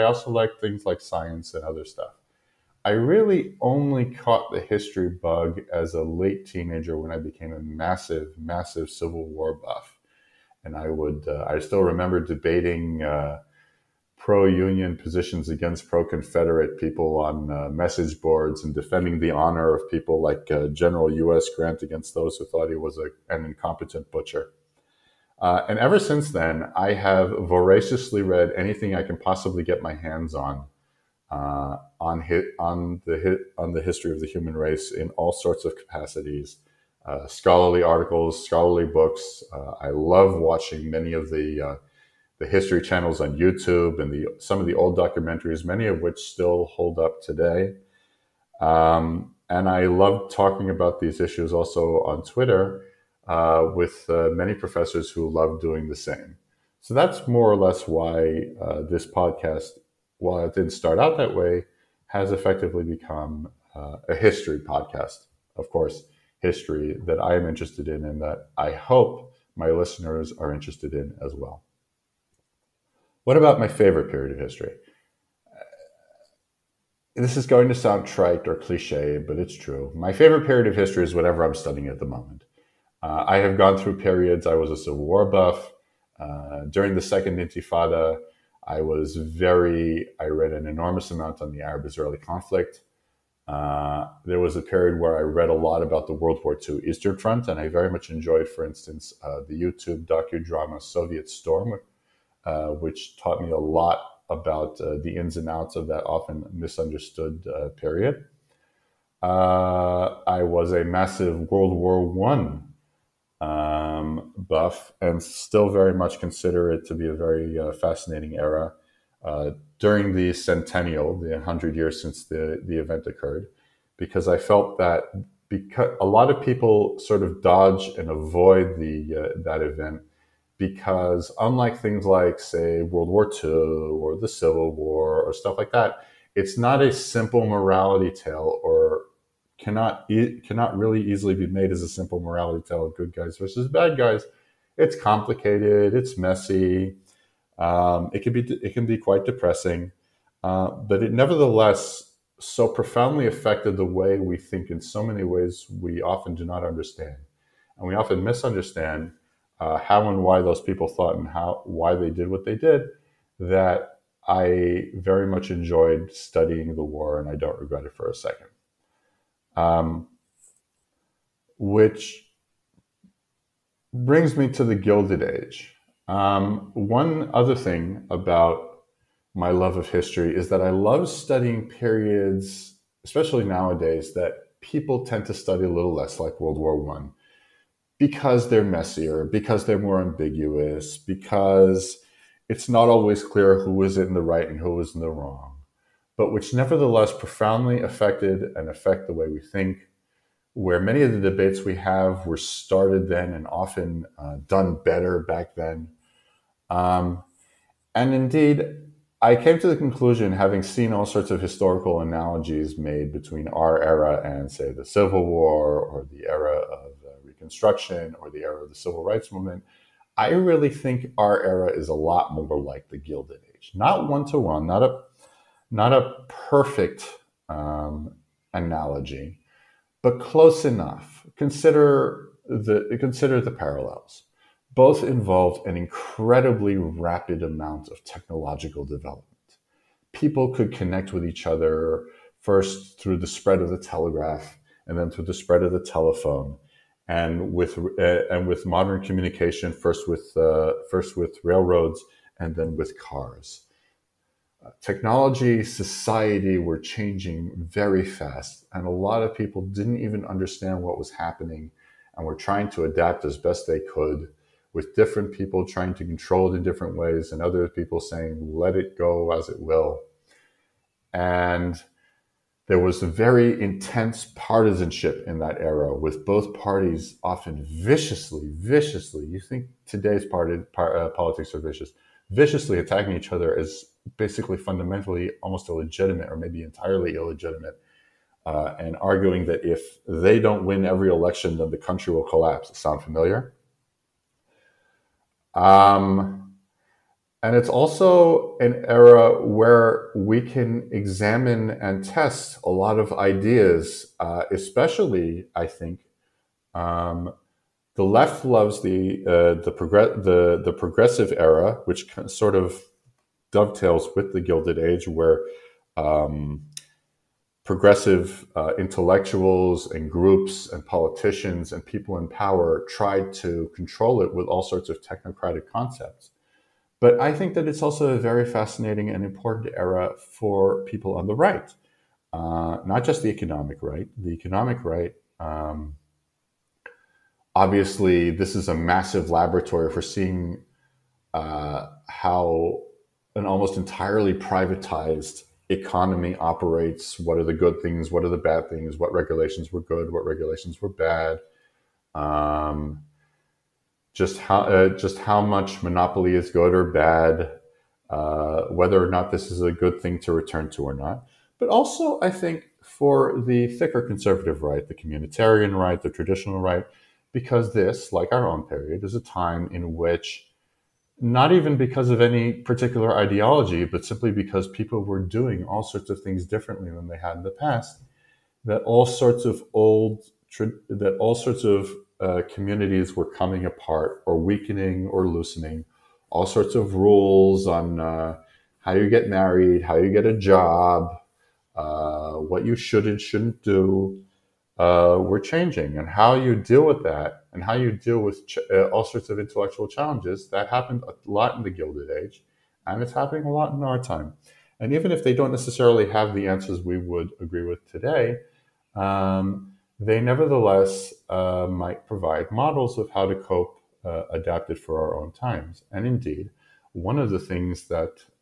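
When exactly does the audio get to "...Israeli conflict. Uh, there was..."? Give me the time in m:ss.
1:31.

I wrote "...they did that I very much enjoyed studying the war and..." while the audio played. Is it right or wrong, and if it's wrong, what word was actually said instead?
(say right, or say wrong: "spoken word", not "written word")
right.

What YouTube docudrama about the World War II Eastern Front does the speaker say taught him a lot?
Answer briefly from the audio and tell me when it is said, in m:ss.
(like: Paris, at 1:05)
Soviet Storm, at 1:40.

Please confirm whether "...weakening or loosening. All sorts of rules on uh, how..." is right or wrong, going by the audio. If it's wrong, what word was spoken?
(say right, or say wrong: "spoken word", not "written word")
right.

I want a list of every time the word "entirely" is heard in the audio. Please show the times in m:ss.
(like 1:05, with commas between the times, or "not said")
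4:46, 5:43.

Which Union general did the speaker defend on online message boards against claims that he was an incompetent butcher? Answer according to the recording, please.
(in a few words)
U.S. Grant.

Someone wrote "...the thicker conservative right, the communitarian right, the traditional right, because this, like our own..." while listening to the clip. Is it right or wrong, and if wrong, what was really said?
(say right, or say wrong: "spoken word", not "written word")
right.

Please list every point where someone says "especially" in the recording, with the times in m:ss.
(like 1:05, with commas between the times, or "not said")
3:03, 5:04.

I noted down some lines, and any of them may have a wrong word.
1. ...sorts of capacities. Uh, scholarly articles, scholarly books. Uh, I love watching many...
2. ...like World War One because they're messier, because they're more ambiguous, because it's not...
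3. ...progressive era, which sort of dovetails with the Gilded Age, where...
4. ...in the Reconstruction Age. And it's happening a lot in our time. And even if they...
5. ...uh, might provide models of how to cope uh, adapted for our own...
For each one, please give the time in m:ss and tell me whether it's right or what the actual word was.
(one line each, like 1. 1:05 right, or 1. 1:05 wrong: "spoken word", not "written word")
1. 0:35 right
2. 3:06 right
3. 5:10 right
4. 6:41 wrong: "Gilded", not "Reconstruction"
5. 6:51 right.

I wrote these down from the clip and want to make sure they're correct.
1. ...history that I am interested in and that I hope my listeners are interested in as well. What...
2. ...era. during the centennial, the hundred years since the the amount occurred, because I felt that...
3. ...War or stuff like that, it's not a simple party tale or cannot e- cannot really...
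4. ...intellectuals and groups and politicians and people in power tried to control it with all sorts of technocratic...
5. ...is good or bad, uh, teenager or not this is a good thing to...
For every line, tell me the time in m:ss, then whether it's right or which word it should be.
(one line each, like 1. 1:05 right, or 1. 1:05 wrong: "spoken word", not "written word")
1. 1:06 right
2. 1:58 wrong: "event", not "amount"
3. 2:14 wrong: "morality", not "party"
4. 5:18 right
5. 5:56 wrong: "whether", not "teenager".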